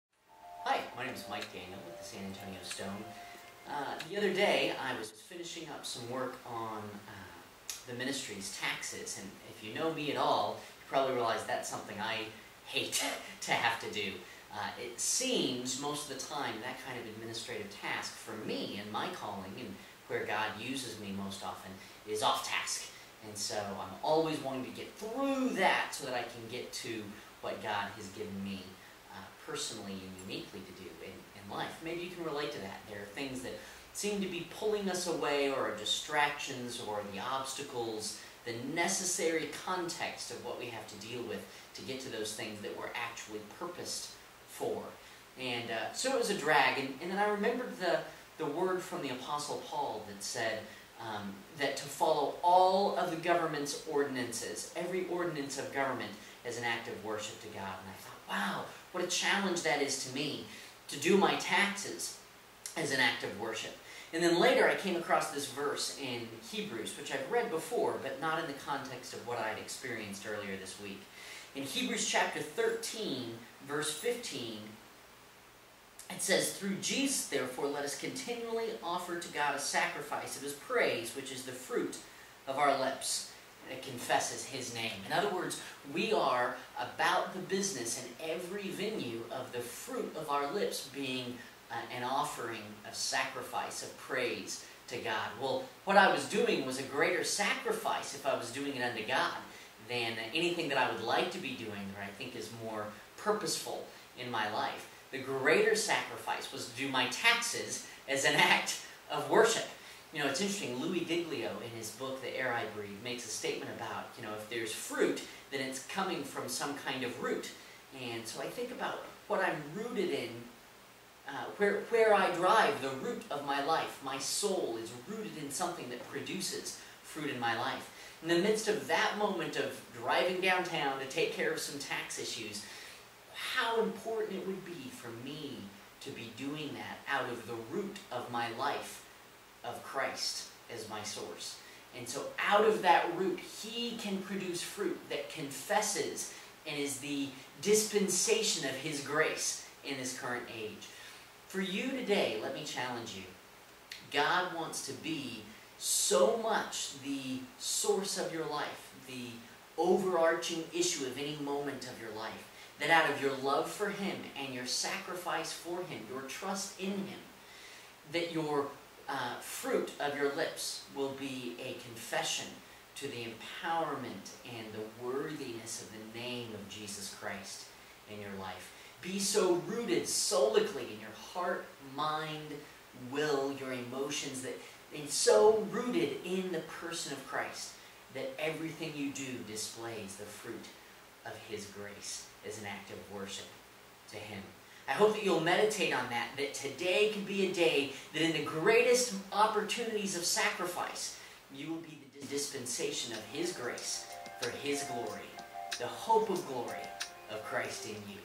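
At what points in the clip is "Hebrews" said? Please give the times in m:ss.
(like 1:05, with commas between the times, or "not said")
1:06, 1:11.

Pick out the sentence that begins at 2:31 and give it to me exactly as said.
For you today, let me challenge you.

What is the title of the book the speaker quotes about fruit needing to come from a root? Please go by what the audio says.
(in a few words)
The Air I Breathe.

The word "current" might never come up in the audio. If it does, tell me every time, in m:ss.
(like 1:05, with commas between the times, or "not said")
2:30.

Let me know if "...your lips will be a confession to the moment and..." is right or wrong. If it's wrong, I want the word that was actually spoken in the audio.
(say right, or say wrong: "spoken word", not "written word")
wrong: "empowerment", not "moment".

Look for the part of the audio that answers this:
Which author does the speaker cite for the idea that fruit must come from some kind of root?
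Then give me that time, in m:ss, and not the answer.
1:50.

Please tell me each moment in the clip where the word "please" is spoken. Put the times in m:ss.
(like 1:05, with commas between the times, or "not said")
not said.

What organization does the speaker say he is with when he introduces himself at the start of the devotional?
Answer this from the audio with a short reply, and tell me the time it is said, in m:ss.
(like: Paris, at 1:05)
San Antonio Stone, at 0:02.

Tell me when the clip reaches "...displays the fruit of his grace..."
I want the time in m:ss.
3:09.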